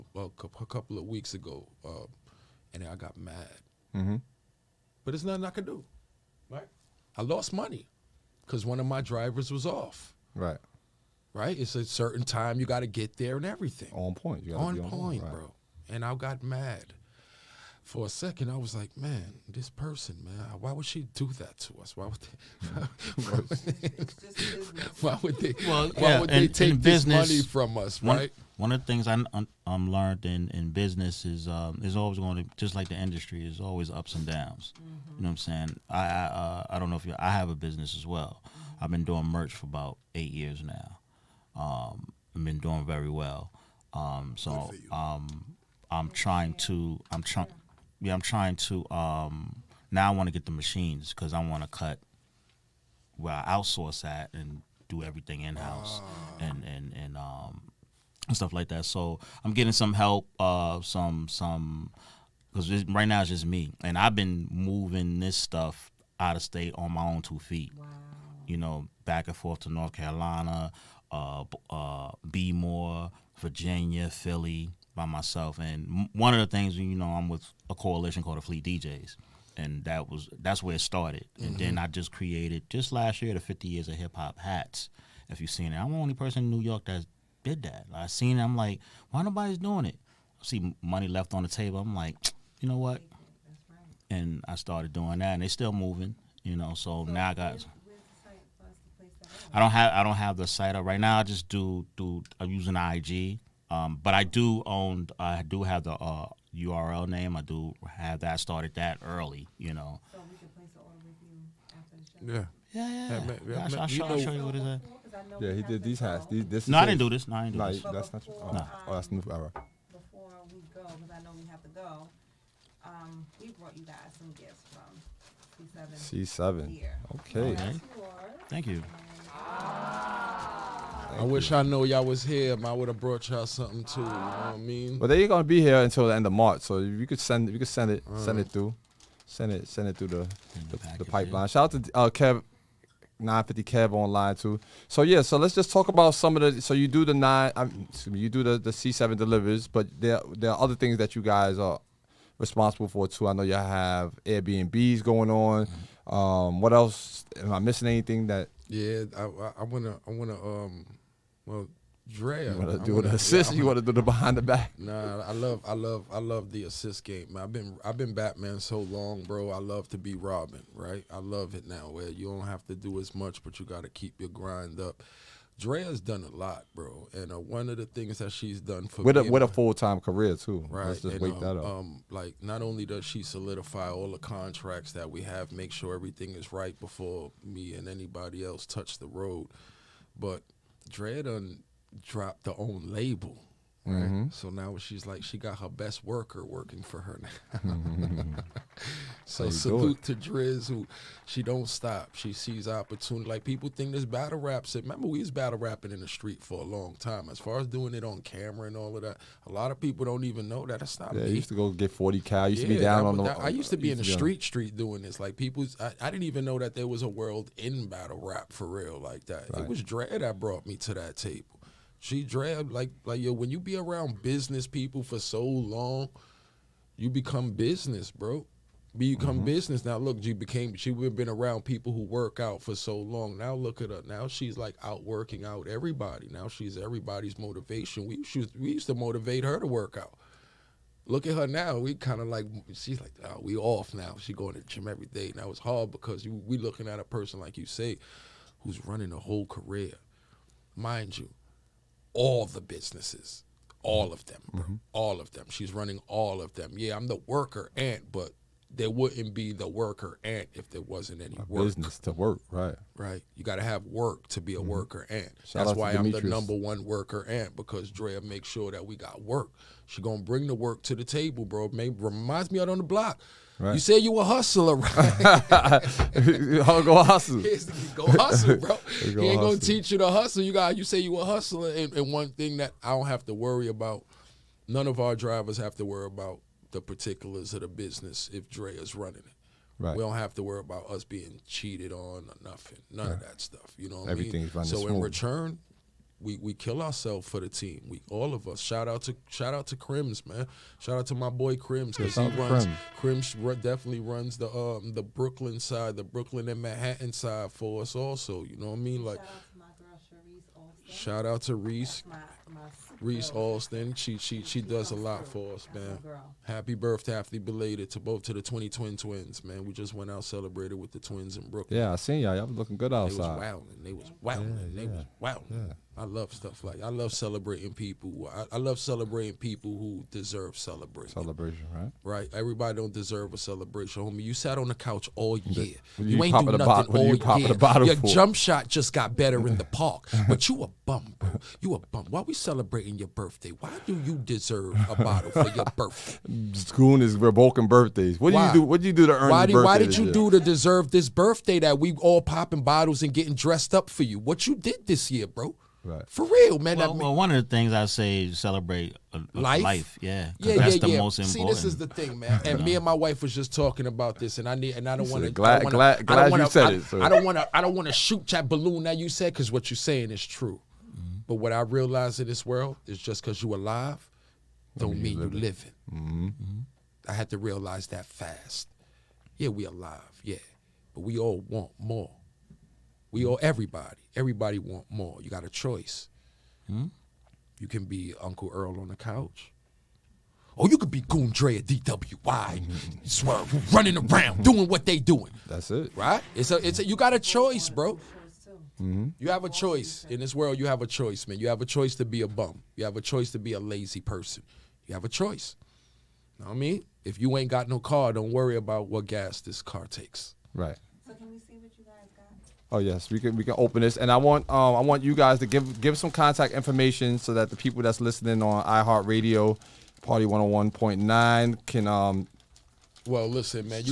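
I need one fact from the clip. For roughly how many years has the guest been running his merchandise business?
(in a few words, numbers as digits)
8 years.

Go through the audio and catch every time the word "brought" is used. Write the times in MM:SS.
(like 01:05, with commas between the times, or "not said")
02:03, 02:12, 03:40.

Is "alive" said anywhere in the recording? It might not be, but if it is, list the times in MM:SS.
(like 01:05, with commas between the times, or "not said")
06:13, 06:19.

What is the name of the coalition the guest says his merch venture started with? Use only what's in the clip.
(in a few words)
Fleet DJs.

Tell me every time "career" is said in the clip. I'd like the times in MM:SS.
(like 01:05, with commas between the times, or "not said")
03:00, 04:09.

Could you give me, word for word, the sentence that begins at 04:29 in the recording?
She gonna bring the work to the table, bro.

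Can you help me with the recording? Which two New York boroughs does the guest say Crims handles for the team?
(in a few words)
Brooklyn and Manhattan.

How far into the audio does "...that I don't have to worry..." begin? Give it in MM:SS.
04:42.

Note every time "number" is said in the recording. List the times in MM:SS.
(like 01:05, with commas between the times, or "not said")
04:26.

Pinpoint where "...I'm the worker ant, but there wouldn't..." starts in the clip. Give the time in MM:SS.
04:16.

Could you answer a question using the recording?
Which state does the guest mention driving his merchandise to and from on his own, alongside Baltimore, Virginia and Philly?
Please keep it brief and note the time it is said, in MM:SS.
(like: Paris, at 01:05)
North Carolina, at 01:09.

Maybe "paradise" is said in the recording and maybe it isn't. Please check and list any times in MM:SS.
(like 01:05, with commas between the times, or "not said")
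not said.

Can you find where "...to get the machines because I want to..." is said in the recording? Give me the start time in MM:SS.
00:50.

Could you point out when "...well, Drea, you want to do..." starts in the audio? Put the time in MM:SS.
02:41.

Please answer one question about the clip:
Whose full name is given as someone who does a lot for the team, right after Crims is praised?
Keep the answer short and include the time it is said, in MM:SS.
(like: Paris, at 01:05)
Reese Alston, at 05:13.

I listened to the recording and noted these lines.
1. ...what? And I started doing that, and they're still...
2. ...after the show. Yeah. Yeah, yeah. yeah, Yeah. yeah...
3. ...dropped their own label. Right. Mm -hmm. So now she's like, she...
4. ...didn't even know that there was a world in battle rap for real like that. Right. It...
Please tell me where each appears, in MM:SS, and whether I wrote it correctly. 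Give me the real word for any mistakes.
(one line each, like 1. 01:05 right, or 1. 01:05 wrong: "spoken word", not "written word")
1. 01:32 right
2. 01:52 right
3. 03:12 right
4. 03:36 right.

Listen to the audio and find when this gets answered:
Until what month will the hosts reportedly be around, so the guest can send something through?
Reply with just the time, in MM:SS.
02:16.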